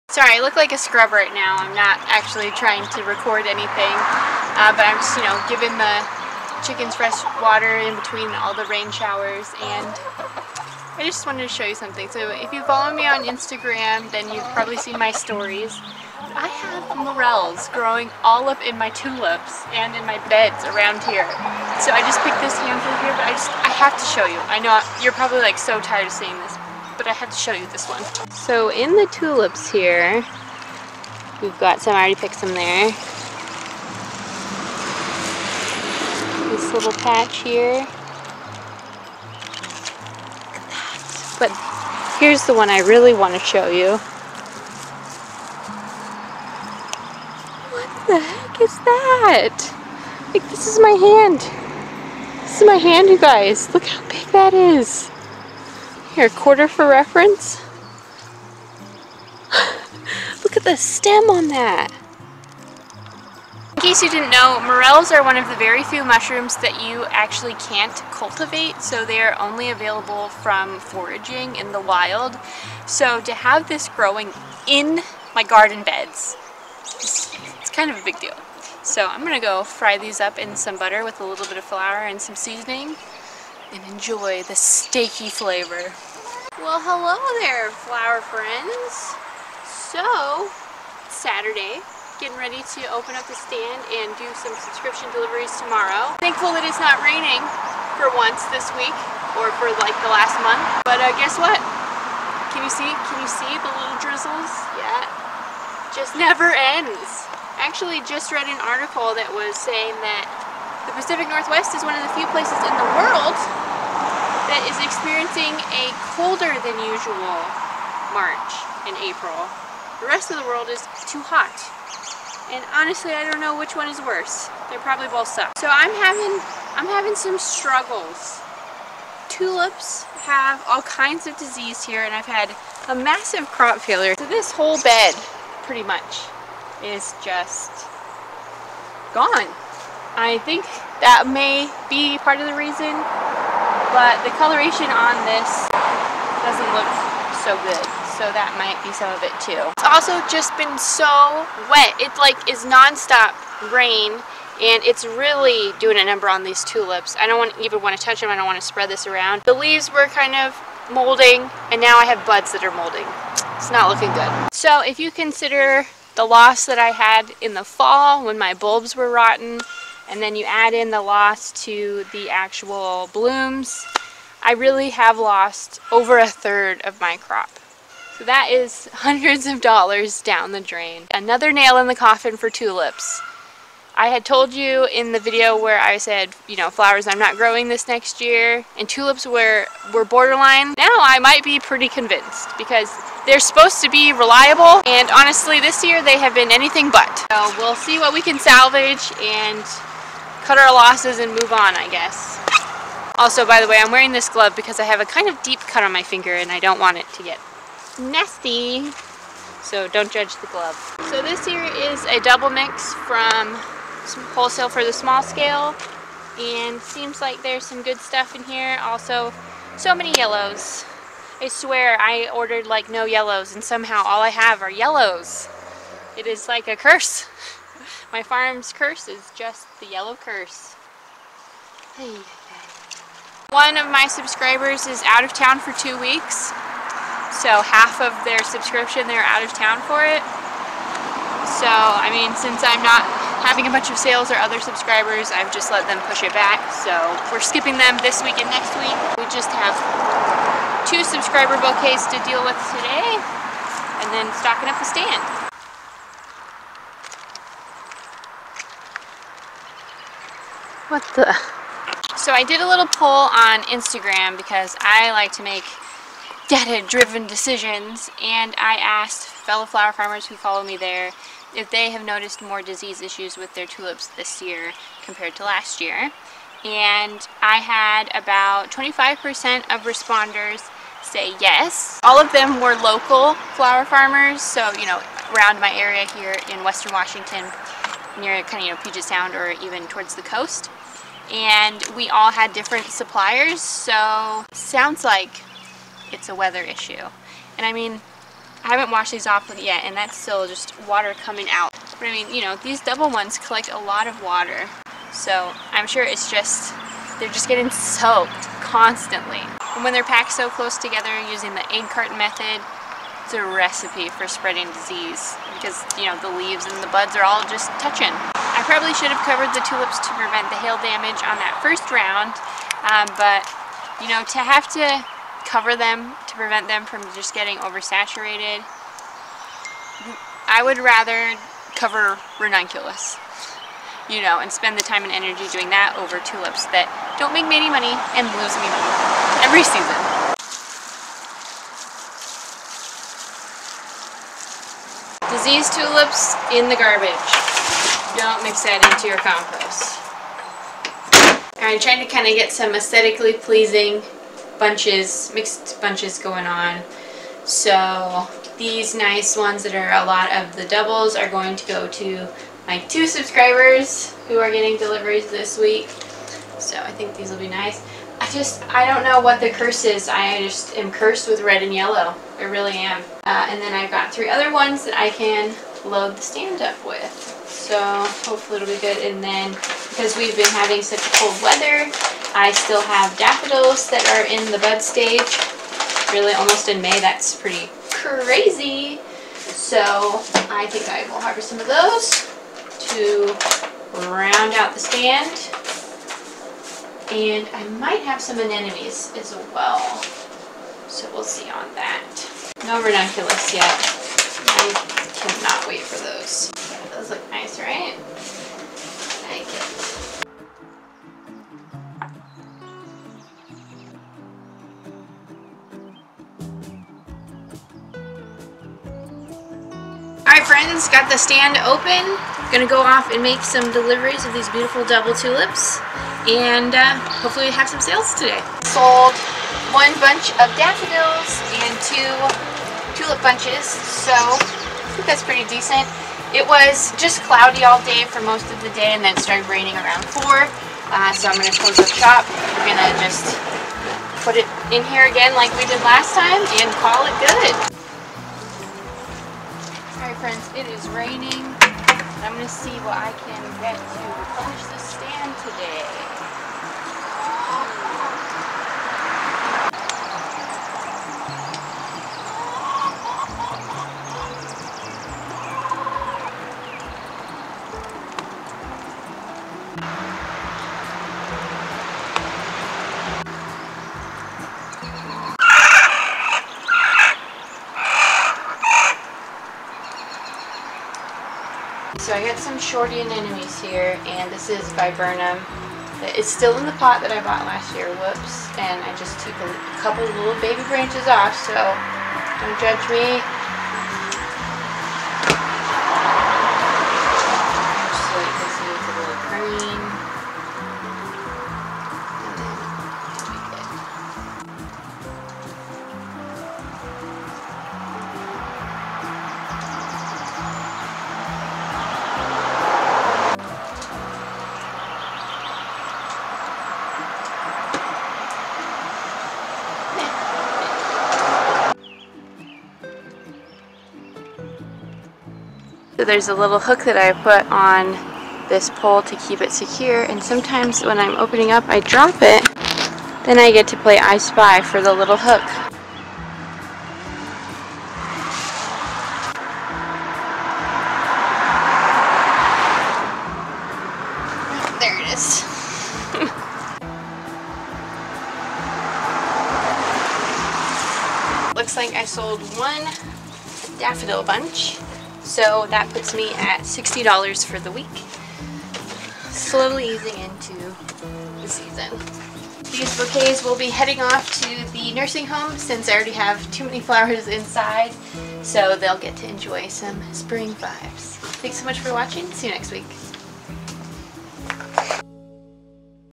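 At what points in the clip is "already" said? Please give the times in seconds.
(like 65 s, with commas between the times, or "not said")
31 s, 565 s.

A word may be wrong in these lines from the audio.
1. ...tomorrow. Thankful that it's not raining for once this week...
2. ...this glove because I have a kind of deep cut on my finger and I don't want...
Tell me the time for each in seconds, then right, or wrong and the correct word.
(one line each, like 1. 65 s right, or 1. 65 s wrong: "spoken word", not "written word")
1. 95 s right
2. 204 s right.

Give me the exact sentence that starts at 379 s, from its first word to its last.
And then because we've been having such cold weather, I still have daffodils that are in the bud stage.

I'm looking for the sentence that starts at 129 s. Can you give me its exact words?
Tulips have all kinds of disease here and I've had a massive crop failure.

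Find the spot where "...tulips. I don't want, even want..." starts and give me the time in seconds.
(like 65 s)
156 s.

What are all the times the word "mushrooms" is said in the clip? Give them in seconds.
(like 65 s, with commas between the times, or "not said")
66 s.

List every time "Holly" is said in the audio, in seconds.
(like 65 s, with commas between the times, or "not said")
not said.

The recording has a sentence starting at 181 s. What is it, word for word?
Another nail in the coffin for tulips.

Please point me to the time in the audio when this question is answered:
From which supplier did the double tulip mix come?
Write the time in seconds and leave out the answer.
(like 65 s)
214 s.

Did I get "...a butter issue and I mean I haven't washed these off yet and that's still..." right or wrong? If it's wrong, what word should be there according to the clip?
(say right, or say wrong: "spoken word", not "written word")
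wrong: "weather", not "butter".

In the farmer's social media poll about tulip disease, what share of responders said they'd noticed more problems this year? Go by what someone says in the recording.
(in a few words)
25%.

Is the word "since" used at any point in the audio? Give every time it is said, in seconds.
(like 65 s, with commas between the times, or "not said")
242 s, 565 s.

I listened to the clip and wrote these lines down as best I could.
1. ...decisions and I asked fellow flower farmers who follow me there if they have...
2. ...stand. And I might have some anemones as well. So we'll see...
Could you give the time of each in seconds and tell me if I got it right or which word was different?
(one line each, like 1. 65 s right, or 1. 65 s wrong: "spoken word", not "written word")
1. 267 s right
2. 394 s right.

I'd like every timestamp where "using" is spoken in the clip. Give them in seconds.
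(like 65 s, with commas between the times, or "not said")
311 s.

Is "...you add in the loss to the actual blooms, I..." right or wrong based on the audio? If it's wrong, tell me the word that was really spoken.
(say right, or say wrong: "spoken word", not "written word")
right.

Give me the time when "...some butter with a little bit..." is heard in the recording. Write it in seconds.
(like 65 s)
80 s.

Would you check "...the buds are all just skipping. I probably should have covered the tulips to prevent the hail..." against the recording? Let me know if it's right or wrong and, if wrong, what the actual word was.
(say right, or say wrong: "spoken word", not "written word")
wrong: "touching", not "skipping".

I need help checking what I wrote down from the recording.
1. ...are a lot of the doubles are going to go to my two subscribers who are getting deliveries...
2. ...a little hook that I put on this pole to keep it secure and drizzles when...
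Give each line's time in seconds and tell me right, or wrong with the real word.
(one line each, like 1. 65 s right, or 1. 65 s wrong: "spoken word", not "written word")
1. 359 s right
2. 526 s wrong: "sometimes", not "drizzles".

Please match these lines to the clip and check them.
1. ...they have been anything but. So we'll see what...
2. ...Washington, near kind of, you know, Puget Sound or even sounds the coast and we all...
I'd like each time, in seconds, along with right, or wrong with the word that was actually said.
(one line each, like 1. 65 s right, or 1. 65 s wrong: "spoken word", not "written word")
1. 196 s right
2. 286 s wrong: "towards", not "sounds".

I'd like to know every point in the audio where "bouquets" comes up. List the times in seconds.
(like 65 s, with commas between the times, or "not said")
251 s, 562 s.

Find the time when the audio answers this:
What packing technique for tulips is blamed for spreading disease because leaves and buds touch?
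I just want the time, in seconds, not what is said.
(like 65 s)
311 s.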